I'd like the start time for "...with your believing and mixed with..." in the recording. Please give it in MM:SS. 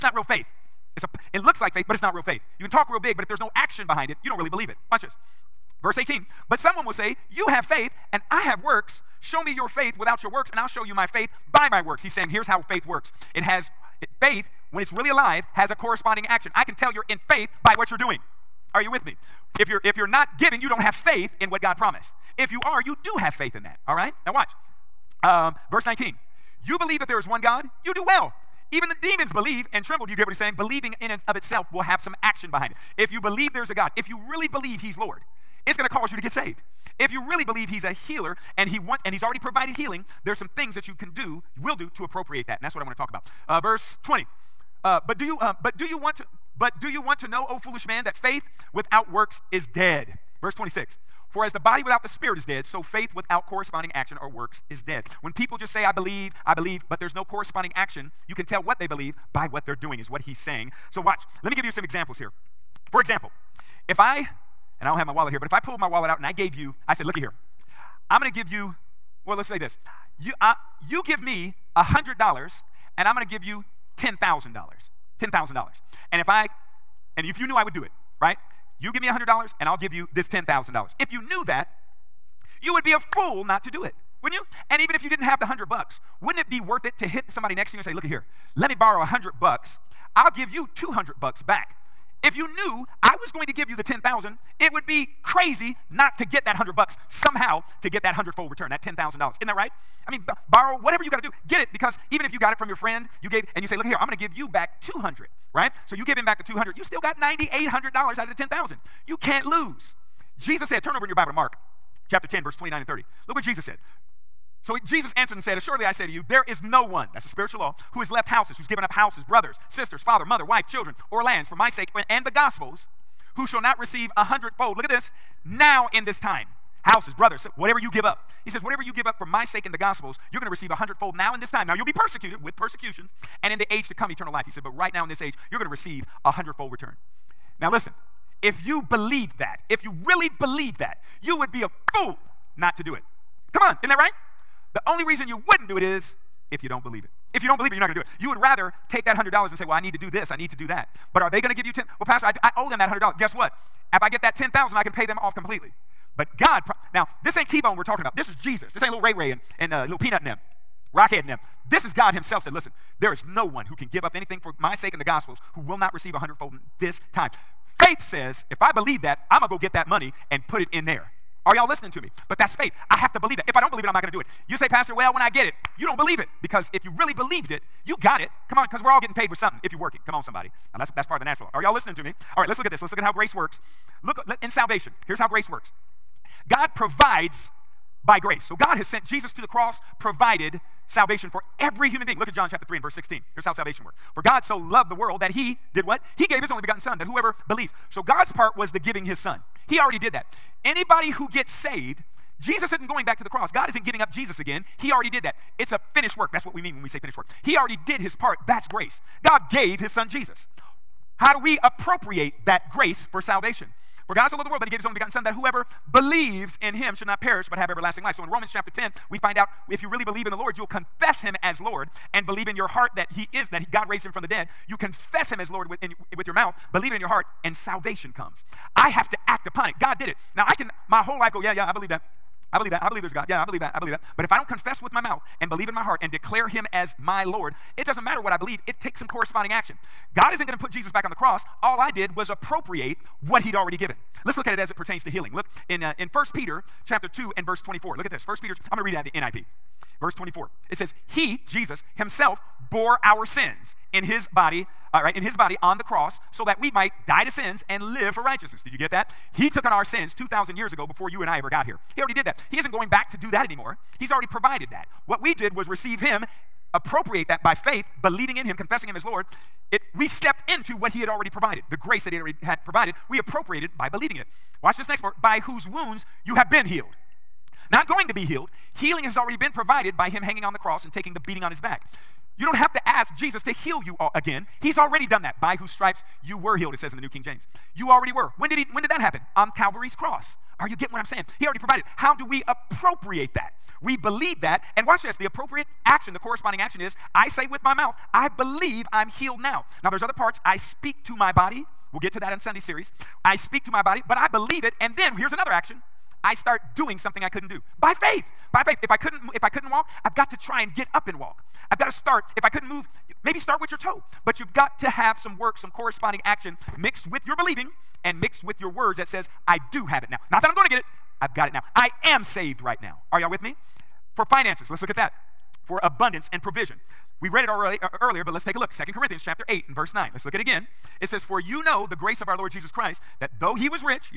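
05:17.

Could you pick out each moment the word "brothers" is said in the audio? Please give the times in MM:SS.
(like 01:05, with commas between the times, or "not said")
01:59, 02:07.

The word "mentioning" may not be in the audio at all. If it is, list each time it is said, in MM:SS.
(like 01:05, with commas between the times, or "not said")
not said.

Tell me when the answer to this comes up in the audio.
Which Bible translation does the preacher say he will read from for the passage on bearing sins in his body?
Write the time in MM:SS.
04:09.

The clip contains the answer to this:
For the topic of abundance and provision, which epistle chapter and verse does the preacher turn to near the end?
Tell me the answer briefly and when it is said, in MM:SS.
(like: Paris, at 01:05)
2 Corinthians 8:9, at 05:28.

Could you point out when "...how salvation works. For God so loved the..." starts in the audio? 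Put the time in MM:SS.
03:13.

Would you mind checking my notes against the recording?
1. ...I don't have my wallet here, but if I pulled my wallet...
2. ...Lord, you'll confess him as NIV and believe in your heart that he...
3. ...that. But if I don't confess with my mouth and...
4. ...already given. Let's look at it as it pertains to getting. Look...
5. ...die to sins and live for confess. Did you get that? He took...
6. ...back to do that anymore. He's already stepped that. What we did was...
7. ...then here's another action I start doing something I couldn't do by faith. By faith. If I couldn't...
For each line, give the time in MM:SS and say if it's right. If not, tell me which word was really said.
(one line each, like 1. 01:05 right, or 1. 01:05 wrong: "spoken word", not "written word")
1. 01:04 right
2. 03:40 wrong: "Lord", not "NIV"
3. 03:53 right
4. 04:03 wrong: "healing", not "getting"
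5. 04:17 wrong: "righteousness", not "confess"
6. 04:22 wrong: "provided", not "stepped"
7. 05:04 right.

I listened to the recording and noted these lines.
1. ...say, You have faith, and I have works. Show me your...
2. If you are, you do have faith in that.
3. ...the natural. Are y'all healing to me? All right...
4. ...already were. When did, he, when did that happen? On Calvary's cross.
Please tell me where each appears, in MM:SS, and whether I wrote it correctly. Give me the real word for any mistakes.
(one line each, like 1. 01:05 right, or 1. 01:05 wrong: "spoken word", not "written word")
1. 00:06 right
2. 00:22 right
3. 03:01 wrong: "listening", not "healing"
4. 04:47 right.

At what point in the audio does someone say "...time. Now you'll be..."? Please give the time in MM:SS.
02:11.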